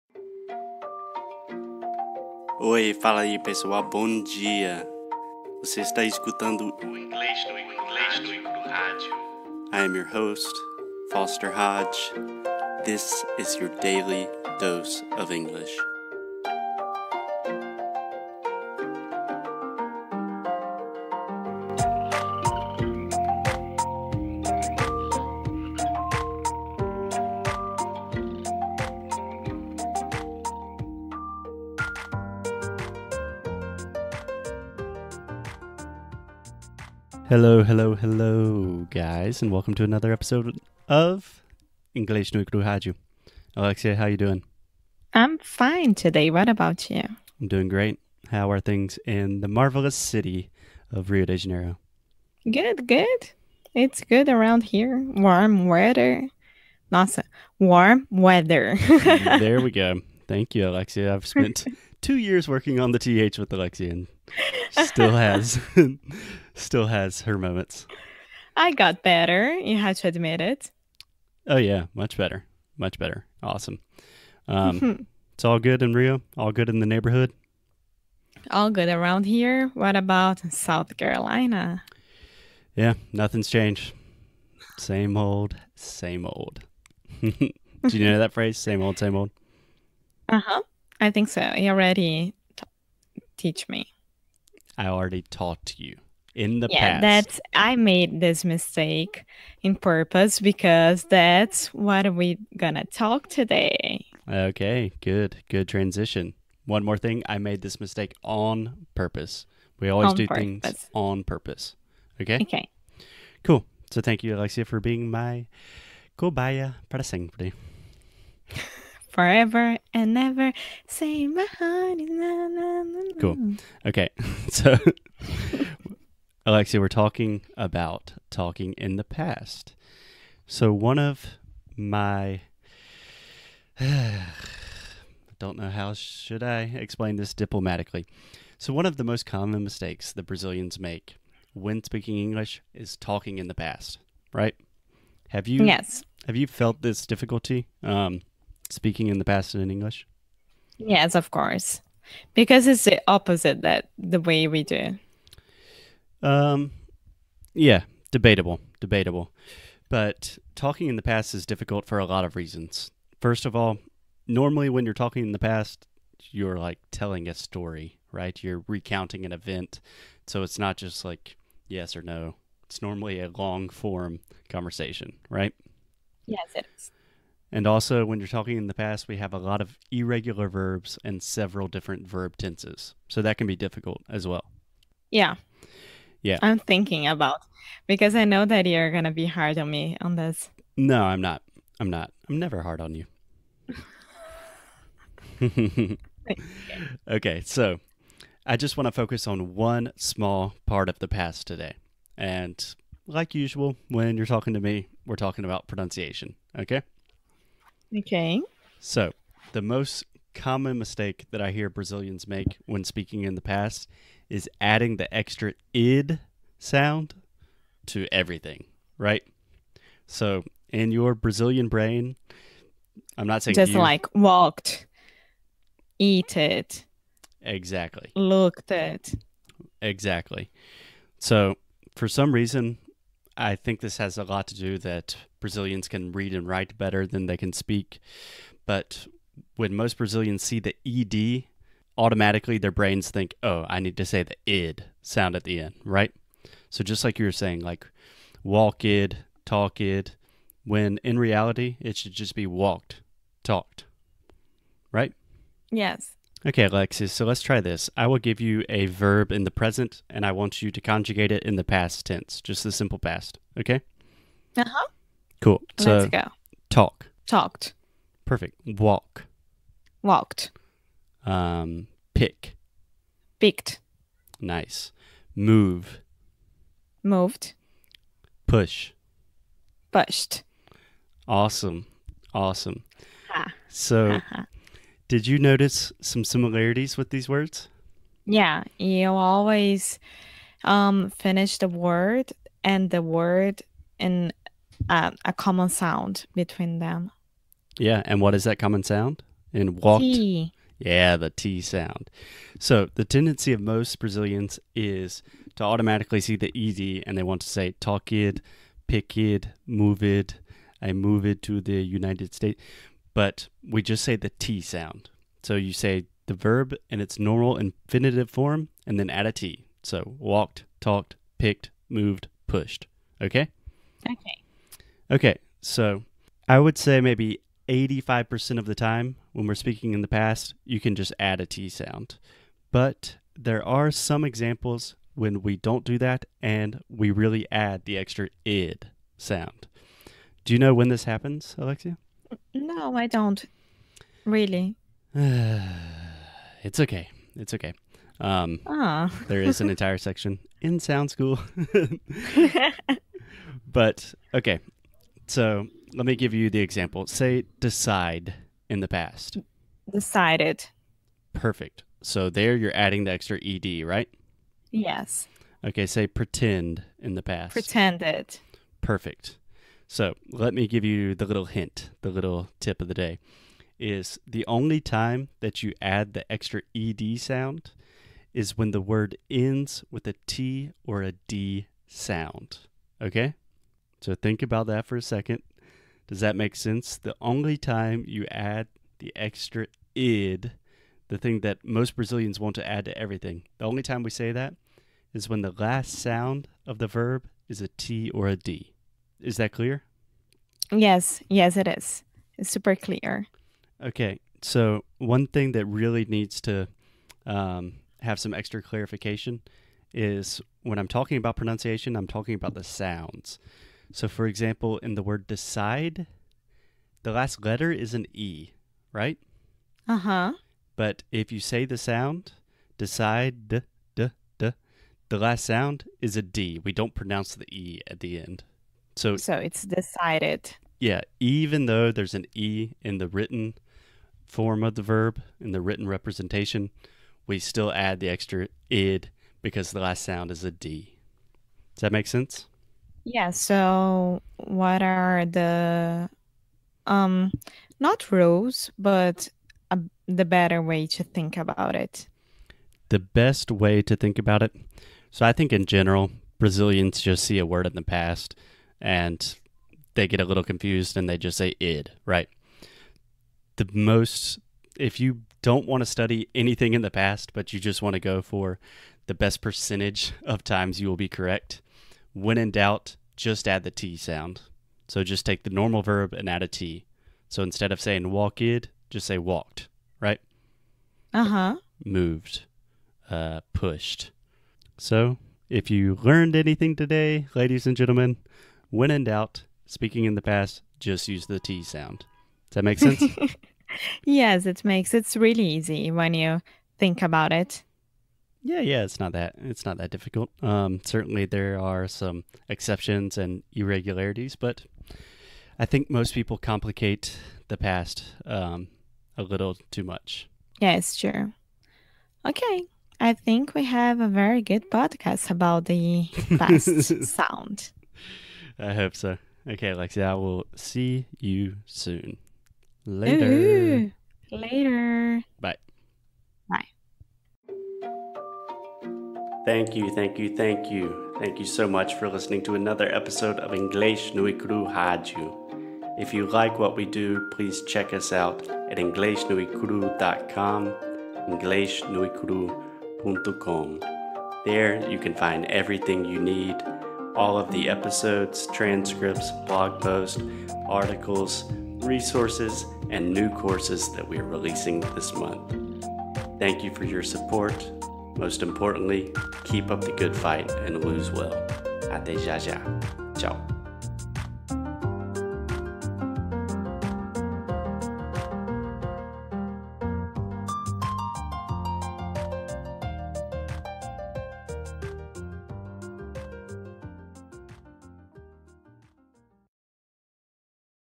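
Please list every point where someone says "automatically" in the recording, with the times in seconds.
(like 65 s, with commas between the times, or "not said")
241 s, 305 s.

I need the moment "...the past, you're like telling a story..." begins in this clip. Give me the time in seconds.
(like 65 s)
165 s.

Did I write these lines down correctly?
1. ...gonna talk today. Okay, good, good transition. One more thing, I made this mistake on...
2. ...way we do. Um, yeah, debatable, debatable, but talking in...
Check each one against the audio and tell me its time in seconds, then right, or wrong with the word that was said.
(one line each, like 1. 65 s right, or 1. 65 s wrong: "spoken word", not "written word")
1. 102 s right
2. 154 s right.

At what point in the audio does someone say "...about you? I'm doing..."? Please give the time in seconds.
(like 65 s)
46 s.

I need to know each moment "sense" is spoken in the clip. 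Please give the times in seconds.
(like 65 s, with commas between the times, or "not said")
386 s, 442 s, 492 s.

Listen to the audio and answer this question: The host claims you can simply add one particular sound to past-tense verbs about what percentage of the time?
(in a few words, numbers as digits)
85%.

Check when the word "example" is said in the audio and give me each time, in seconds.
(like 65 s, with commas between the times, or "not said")
334 s, 356 s, 414 s.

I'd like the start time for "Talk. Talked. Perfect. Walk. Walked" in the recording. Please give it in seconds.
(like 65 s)
266 s.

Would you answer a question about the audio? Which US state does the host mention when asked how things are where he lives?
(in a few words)
South Carolina.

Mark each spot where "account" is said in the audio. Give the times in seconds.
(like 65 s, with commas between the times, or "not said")
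not said.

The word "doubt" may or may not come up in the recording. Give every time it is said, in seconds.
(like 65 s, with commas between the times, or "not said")
472 s, 489 s.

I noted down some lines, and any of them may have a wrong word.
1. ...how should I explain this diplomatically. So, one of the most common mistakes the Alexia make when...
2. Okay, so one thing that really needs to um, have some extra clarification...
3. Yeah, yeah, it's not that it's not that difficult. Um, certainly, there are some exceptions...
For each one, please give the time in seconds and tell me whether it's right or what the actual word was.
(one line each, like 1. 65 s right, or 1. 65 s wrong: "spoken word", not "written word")
1. 135 s wrong: "Brazilians", not "Alexia"
2. 403 s right
3. 498 s right.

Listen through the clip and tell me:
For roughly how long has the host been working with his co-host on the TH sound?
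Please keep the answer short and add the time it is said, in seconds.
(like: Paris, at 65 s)
two years, at 62 s.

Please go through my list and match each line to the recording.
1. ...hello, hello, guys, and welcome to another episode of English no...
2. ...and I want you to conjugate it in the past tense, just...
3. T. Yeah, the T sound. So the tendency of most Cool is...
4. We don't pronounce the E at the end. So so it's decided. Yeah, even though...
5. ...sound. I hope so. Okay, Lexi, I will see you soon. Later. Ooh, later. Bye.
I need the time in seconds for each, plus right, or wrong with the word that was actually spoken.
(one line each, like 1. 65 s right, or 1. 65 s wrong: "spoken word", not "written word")
1. 37 s right
2. 260 s right
3. 300 s wrong: "Brazilians", not "Cool"
4. 426 s right
5. 517 s right.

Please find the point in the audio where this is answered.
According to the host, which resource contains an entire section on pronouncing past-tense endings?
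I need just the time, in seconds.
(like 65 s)
350 s.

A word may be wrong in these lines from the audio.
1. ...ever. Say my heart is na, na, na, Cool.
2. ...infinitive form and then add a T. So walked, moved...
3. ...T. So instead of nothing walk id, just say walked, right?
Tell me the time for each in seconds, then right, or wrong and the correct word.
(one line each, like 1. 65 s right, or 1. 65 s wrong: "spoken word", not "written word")
1. 120 s right
2. 317 s wrong: "talked", not "moved"
3. 476 s wrong: "saying", not "nothing".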